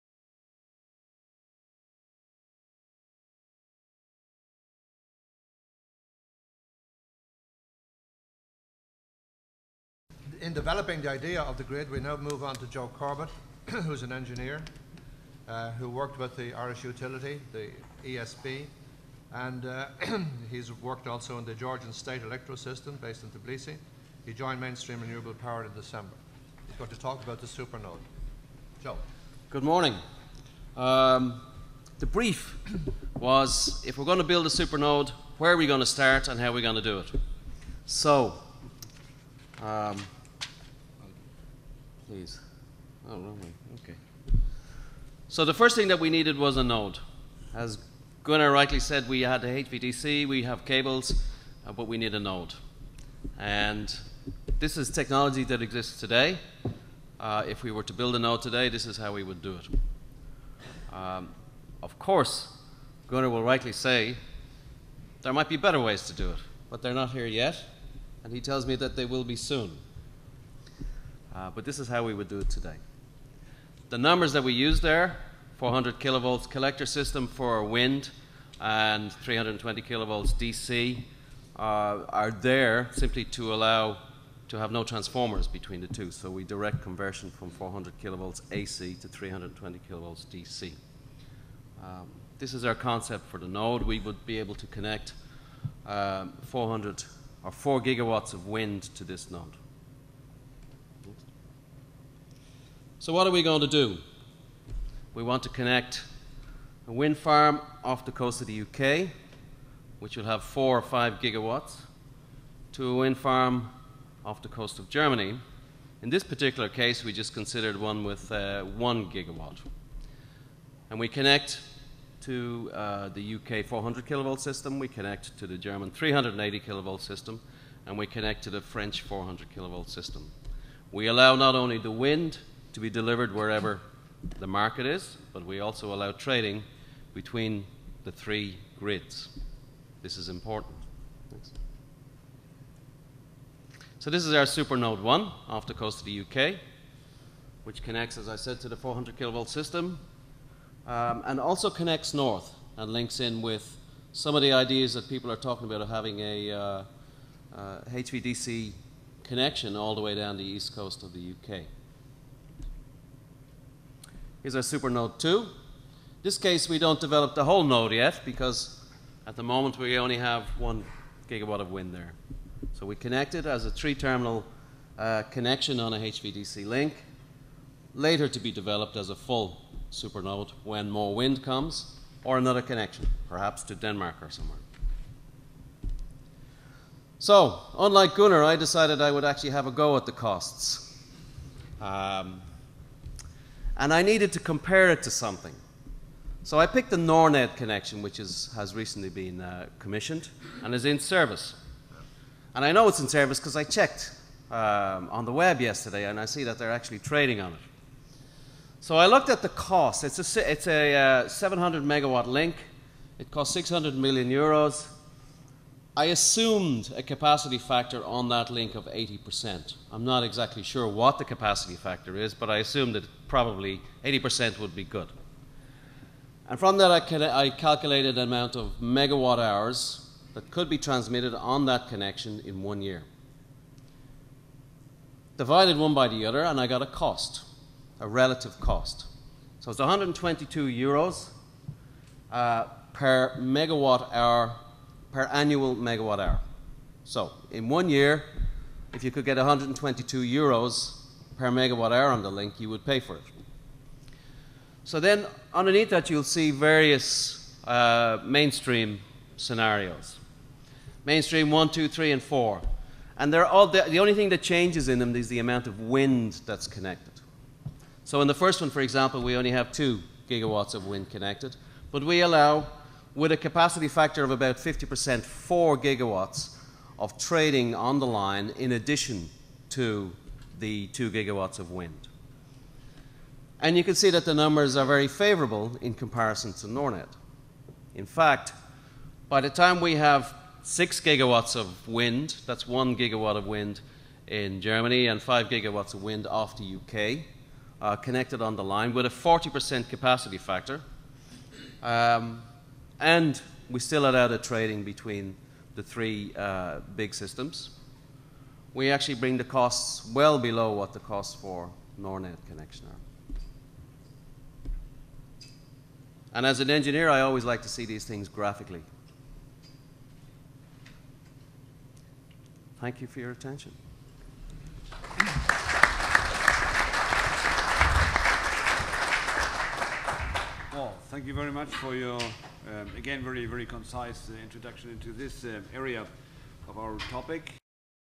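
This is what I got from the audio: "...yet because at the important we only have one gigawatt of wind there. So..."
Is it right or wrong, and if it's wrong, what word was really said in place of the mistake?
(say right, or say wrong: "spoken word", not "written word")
wrong: "moment", not "important".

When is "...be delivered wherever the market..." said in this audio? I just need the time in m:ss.
2:12.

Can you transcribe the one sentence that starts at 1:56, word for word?
In this particular case, we just considered one with uh, one gigawatt.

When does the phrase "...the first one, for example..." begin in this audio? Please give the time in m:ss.
4:28.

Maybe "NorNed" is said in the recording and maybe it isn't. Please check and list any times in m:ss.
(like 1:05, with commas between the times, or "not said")
3:16, 4:46, 5:11.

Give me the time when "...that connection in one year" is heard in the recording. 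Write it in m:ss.
3:51.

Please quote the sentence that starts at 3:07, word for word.
So, unlike Gunnar, I decided I would actually have a go at the costs.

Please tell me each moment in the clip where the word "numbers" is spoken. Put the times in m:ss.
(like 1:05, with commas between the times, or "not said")
1:13, 4:44.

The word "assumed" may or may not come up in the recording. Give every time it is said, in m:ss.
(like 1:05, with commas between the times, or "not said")
3:36, 3:42.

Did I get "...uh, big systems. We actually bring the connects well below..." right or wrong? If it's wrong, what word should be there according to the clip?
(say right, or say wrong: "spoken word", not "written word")
wrong: "costs", not "connects".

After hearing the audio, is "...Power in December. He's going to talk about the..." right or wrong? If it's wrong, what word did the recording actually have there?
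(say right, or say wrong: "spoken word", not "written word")
right.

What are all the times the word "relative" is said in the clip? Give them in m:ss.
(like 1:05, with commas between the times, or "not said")
3:58.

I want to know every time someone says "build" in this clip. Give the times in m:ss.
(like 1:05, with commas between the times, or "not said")
0:34, 0:57.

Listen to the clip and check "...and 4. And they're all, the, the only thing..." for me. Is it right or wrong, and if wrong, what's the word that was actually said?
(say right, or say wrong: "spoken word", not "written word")
right.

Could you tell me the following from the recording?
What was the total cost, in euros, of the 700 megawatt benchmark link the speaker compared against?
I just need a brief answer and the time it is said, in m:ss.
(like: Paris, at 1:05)
600 million euros, at 3:33.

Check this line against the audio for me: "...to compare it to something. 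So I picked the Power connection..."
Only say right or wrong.
wrong.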